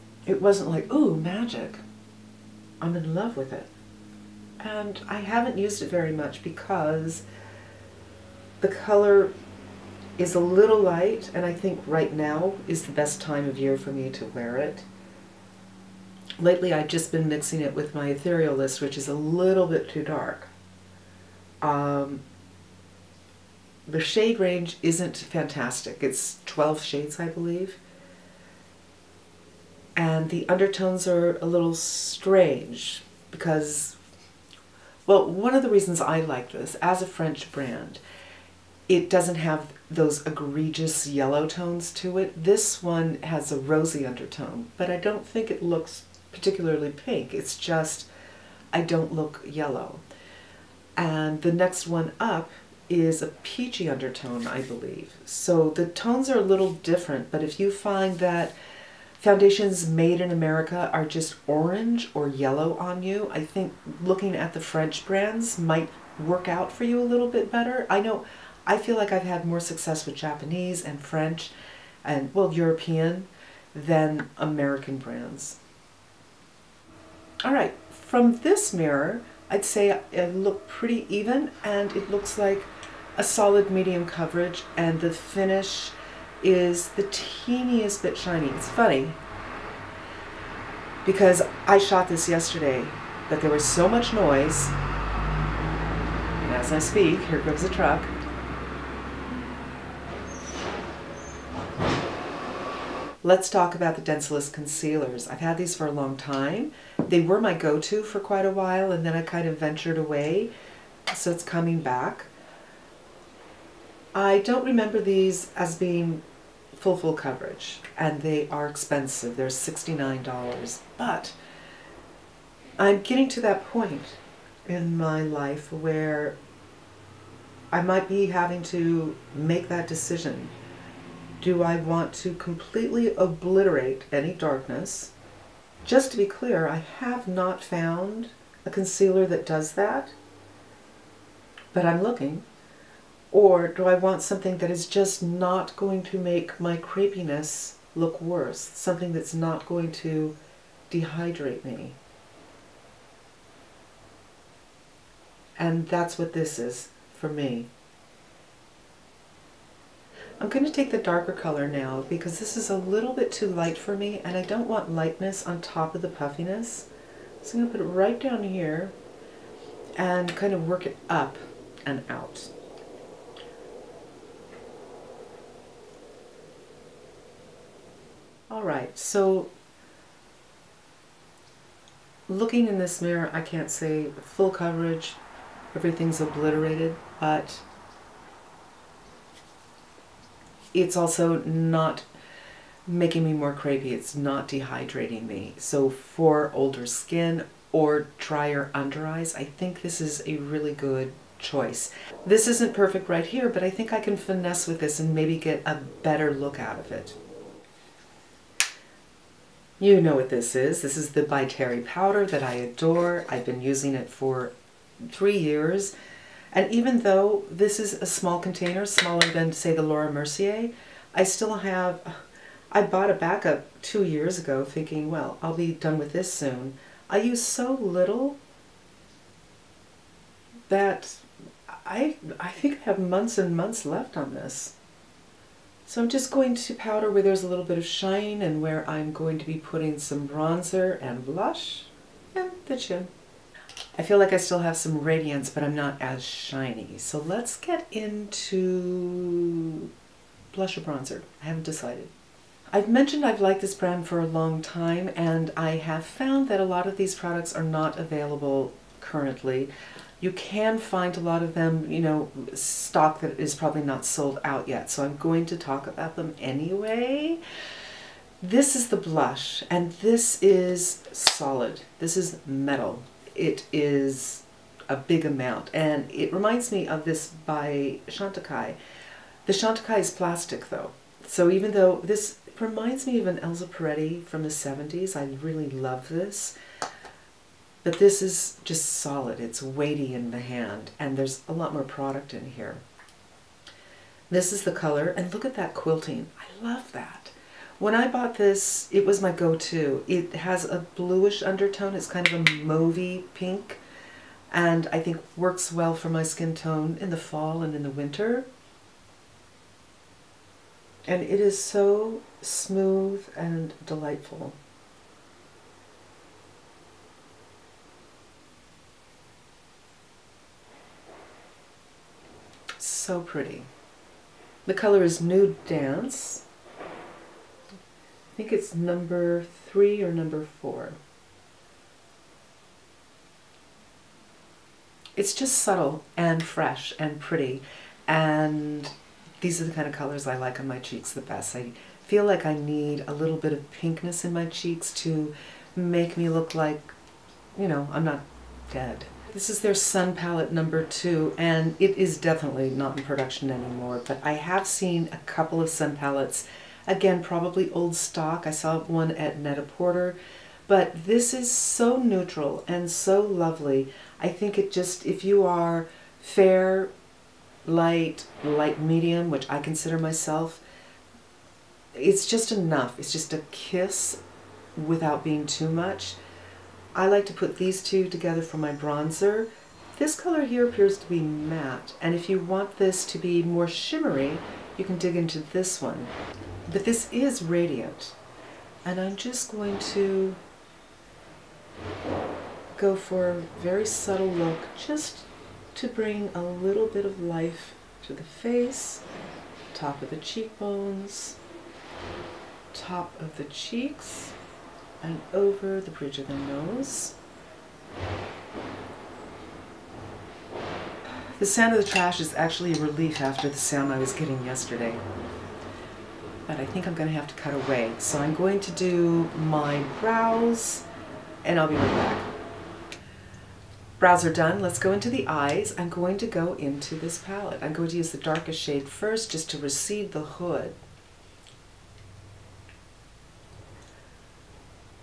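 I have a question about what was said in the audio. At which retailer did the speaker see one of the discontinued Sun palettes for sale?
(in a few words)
Net-a-Porter.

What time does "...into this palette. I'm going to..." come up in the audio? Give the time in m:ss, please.
7:06.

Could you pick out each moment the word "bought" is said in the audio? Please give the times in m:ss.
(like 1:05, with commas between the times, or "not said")
3:42, 4:58.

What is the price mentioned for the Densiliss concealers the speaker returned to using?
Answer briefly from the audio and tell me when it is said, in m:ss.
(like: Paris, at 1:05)
$69, at 1:59.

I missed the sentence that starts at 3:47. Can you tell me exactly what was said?
I use so little that I, I think I have months and months left on this.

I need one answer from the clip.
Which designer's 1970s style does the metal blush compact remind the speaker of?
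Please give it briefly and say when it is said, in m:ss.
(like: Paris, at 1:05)
Elsa Peretti, at 4:43.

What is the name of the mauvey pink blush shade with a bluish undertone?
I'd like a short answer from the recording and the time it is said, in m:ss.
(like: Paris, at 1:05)
Nude Dance, at 5:25.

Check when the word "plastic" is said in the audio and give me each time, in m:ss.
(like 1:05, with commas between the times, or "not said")
4:40.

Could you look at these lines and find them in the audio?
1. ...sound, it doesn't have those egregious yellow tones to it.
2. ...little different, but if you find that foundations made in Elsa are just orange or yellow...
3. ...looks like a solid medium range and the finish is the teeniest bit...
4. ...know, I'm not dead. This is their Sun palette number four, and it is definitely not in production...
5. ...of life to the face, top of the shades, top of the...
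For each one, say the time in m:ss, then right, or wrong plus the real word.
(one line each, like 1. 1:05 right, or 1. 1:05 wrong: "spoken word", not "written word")
1. 0:37 wrong: "brand", not "sound"
2. 0:56 wrong: "America", not "Elsa"
3. 1:22 wrong: "coverage", not "range"
4. 5:47 wrong: "two", not "four"
5. 6:37 wrong: "cheekbones", not "shades".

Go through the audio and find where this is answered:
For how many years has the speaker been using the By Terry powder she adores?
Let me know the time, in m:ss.
3:35.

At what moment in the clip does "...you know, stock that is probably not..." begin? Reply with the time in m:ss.
4:21.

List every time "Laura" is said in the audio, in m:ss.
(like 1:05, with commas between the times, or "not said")
3:39.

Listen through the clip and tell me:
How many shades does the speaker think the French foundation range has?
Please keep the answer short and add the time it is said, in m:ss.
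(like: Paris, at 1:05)
12, at 0:26.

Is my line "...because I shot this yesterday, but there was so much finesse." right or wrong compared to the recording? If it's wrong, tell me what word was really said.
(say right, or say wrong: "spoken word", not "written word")
wrong: "noise", not "finesse".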